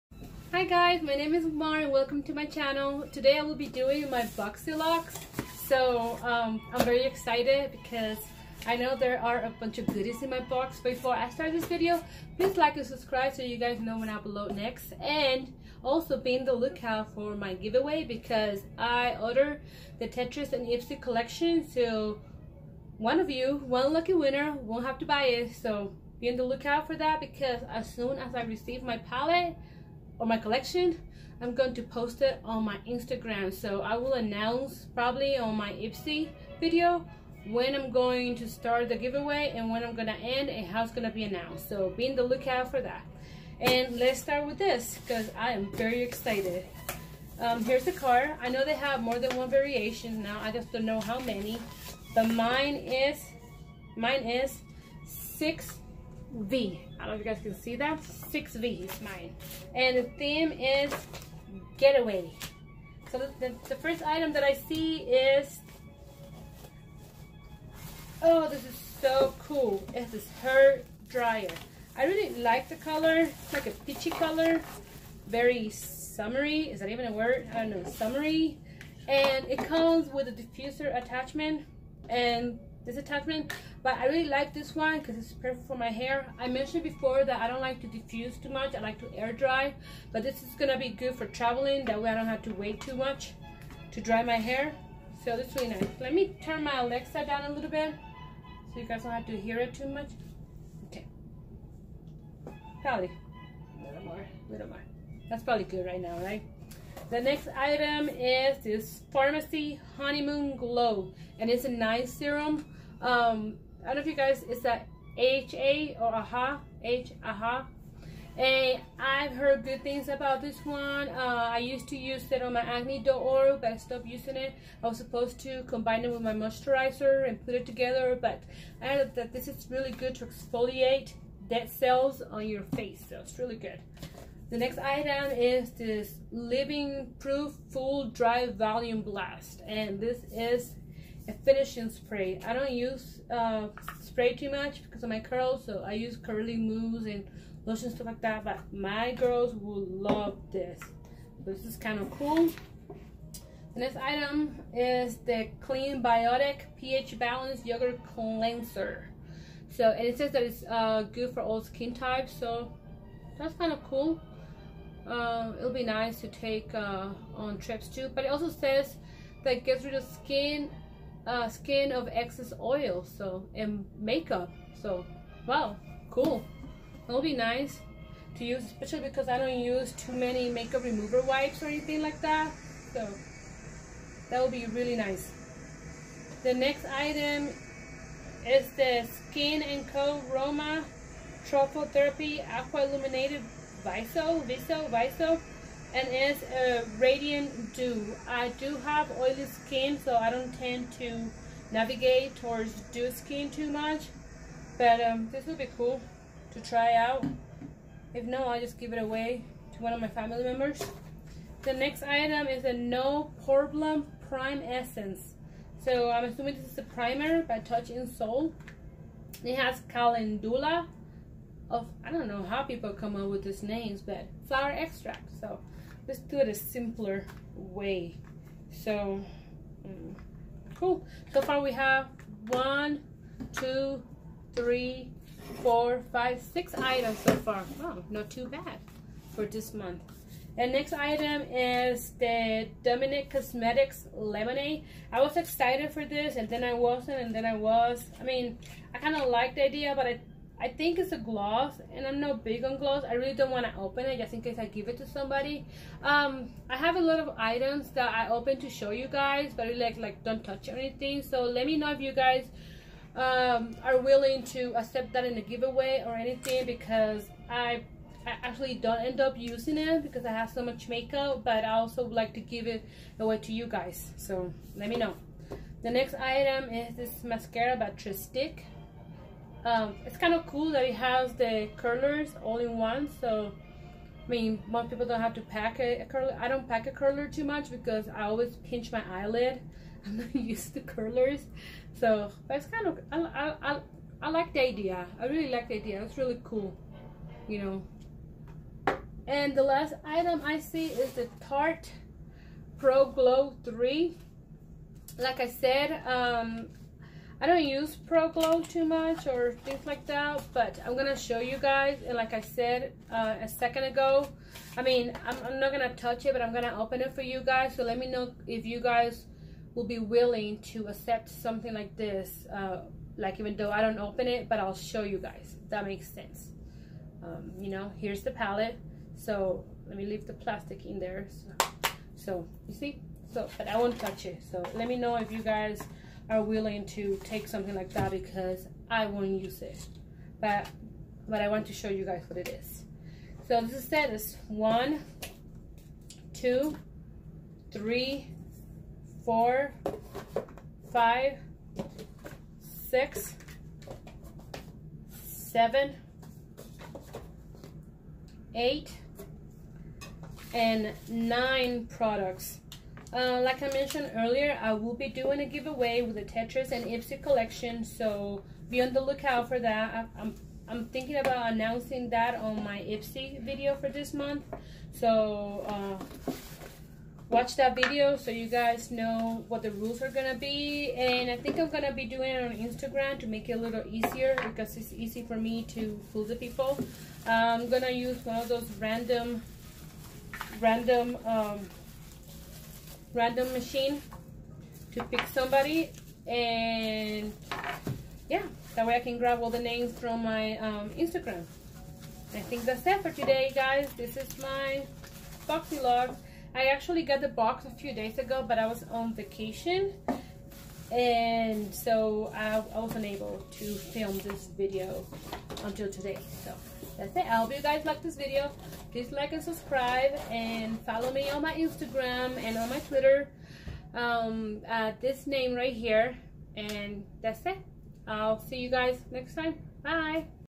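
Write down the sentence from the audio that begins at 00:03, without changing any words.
Today I will be doing my Boxyluxe.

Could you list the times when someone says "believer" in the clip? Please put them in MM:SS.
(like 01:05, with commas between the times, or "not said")
not said.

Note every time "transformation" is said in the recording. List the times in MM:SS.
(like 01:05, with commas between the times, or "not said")
not said.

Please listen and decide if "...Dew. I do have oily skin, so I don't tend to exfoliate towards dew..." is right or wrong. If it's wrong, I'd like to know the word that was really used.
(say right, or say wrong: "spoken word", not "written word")
wrong: "navigate", not "exfoliate".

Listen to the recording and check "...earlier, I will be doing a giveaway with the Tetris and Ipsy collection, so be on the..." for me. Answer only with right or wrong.
right.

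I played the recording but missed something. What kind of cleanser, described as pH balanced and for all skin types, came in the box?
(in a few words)
Yogurt Cleanser.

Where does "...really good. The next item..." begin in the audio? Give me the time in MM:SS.
02:13.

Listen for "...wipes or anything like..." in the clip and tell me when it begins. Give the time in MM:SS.
03:01.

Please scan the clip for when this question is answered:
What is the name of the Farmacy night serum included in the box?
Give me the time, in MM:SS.
01:49.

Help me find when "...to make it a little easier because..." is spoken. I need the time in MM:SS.
06:23.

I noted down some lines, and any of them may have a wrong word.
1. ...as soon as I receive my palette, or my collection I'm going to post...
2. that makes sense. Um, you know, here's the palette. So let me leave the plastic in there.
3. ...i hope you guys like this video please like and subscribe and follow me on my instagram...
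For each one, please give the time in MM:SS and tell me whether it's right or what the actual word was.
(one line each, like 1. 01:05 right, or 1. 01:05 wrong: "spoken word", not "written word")
1. 00:27 right
2. 05:25 right
3. 06:57 right.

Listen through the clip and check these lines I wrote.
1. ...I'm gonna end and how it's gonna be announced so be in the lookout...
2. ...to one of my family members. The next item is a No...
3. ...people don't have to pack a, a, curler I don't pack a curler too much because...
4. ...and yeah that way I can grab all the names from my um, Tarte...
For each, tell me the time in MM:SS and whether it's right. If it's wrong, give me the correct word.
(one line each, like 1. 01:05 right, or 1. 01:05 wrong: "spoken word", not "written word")
1. 00:39 right
2. 03:29 right
3. 04:44 right
4. 06:36 wrong: "Instagram", not "Tarte".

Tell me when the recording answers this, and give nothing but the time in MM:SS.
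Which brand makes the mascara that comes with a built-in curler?
04:37.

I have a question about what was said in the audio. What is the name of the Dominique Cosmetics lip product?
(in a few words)
Lemonade.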